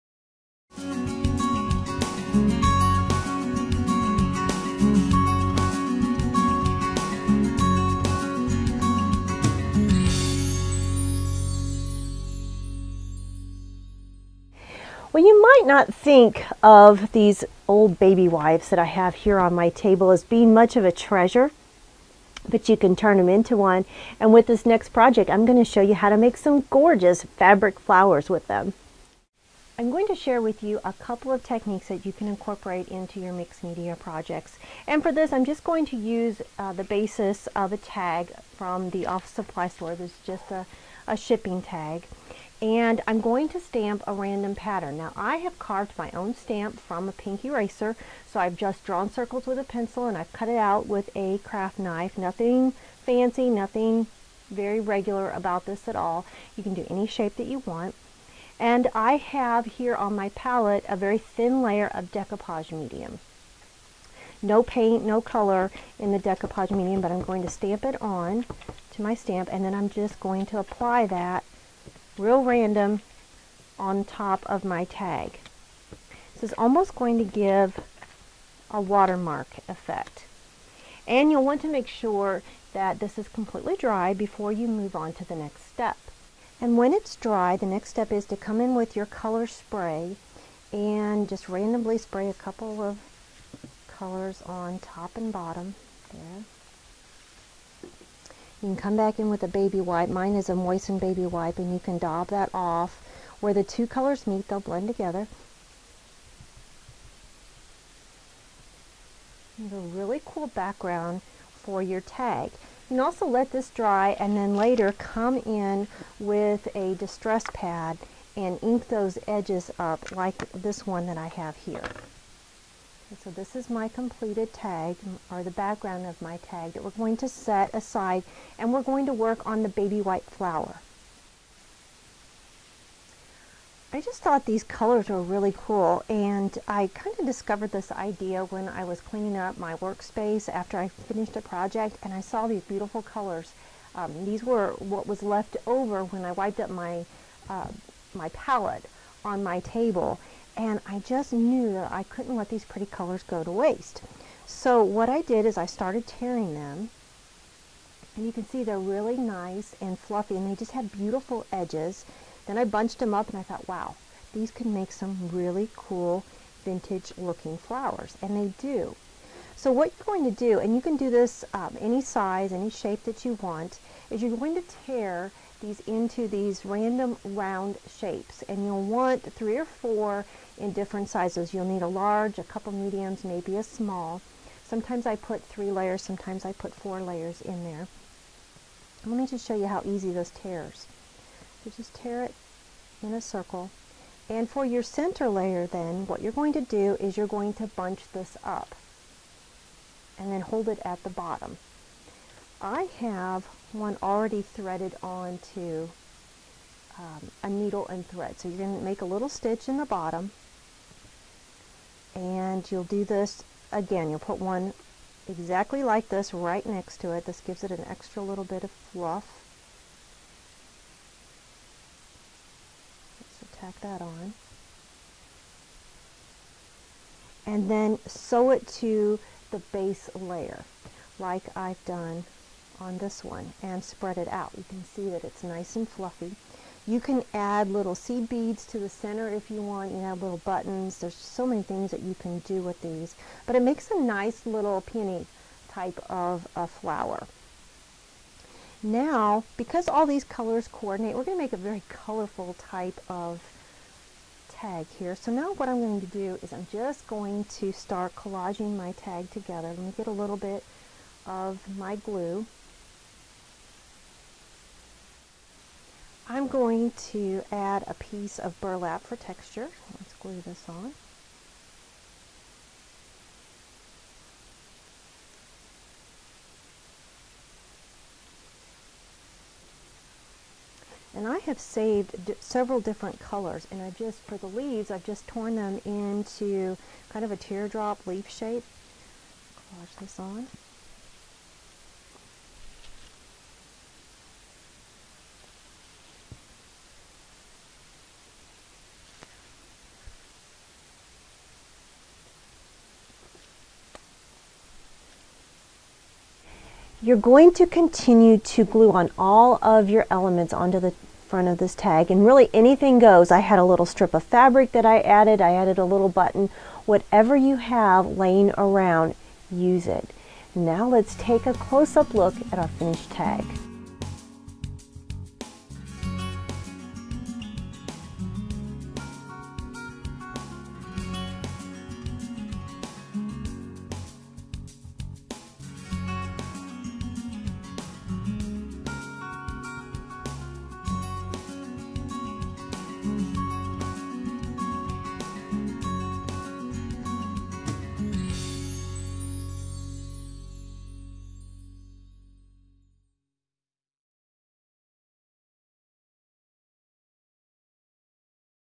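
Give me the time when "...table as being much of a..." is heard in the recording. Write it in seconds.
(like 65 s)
19 s.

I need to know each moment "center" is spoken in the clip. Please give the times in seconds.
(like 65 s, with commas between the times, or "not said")
194 s, 238 s.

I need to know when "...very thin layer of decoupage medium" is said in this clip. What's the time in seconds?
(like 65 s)
60 s.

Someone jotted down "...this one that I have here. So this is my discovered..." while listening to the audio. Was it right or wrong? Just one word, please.
wrong.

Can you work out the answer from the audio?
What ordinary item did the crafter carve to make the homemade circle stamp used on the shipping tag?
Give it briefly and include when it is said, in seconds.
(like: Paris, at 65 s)
Pink eraser, at 47 s.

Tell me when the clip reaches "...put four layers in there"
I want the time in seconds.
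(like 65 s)
186 s.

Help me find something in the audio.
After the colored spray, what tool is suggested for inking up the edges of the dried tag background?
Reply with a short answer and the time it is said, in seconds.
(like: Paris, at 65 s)
Distress pad, at 116 s.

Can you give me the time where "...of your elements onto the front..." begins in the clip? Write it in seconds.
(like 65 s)
309 s.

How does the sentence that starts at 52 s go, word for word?
Nothing fancy, nothing very regular about this at all.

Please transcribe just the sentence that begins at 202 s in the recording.
I have one already threaded onto um, a needle and thread.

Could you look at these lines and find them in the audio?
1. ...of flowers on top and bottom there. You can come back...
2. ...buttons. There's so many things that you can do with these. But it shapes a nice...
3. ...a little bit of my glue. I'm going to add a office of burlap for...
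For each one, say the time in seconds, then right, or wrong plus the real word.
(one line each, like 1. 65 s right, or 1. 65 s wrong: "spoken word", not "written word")
1. 92 s wrong: "colors", not "flowers"
2. 240 s wrong: "makes", not "shapes"
3. 260 s wrong: "piece", not "office".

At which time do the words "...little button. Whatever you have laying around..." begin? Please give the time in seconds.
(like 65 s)
315 s.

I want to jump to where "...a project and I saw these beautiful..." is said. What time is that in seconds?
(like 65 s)
141 s.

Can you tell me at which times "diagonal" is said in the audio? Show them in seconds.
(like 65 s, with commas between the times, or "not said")
not said.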